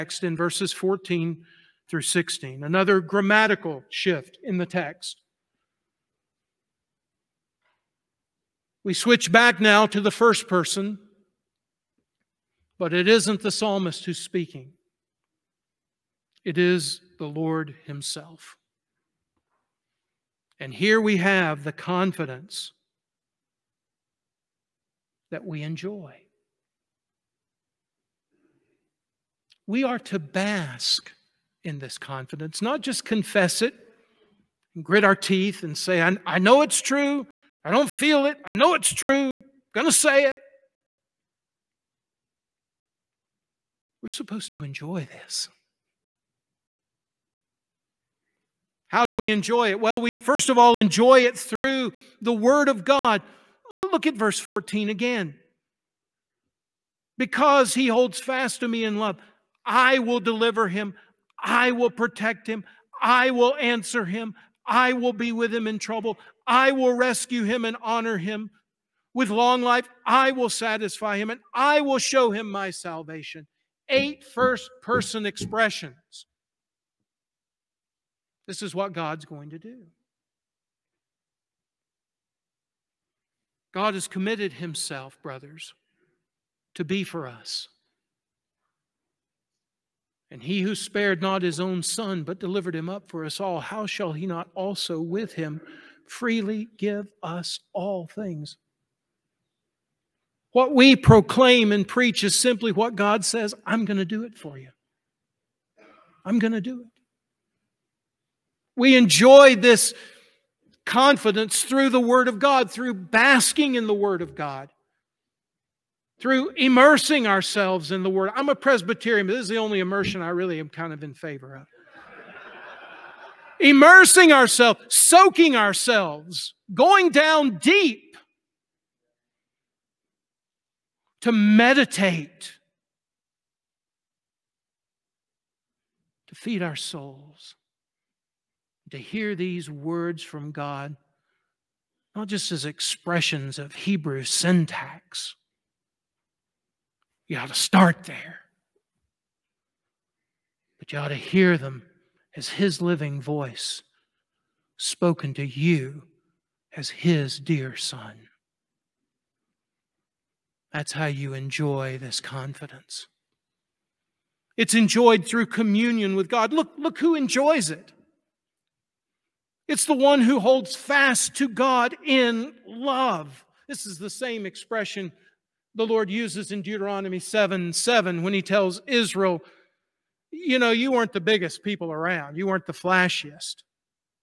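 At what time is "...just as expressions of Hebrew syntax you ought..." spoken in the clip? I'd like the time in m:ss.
2:22.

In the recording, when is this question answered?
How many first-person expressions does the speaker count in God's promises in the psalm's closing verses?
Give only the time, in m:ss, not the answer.
1:13.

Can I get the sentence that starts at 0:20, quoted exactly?
And here we have the confidence that we enjoy.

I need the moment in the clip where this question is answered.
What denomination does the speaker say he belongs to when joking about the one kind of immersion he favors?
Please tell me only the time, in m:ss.
1:58.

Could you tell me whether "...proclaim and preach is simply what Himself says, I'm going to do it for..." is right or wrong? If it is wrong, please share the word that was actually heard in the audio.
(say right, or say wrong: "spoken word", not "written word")
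wrong: "God", not "Himself".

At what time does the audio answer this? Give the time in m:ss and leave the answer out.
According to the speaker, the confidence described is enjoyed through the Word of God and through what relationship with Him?
2:45.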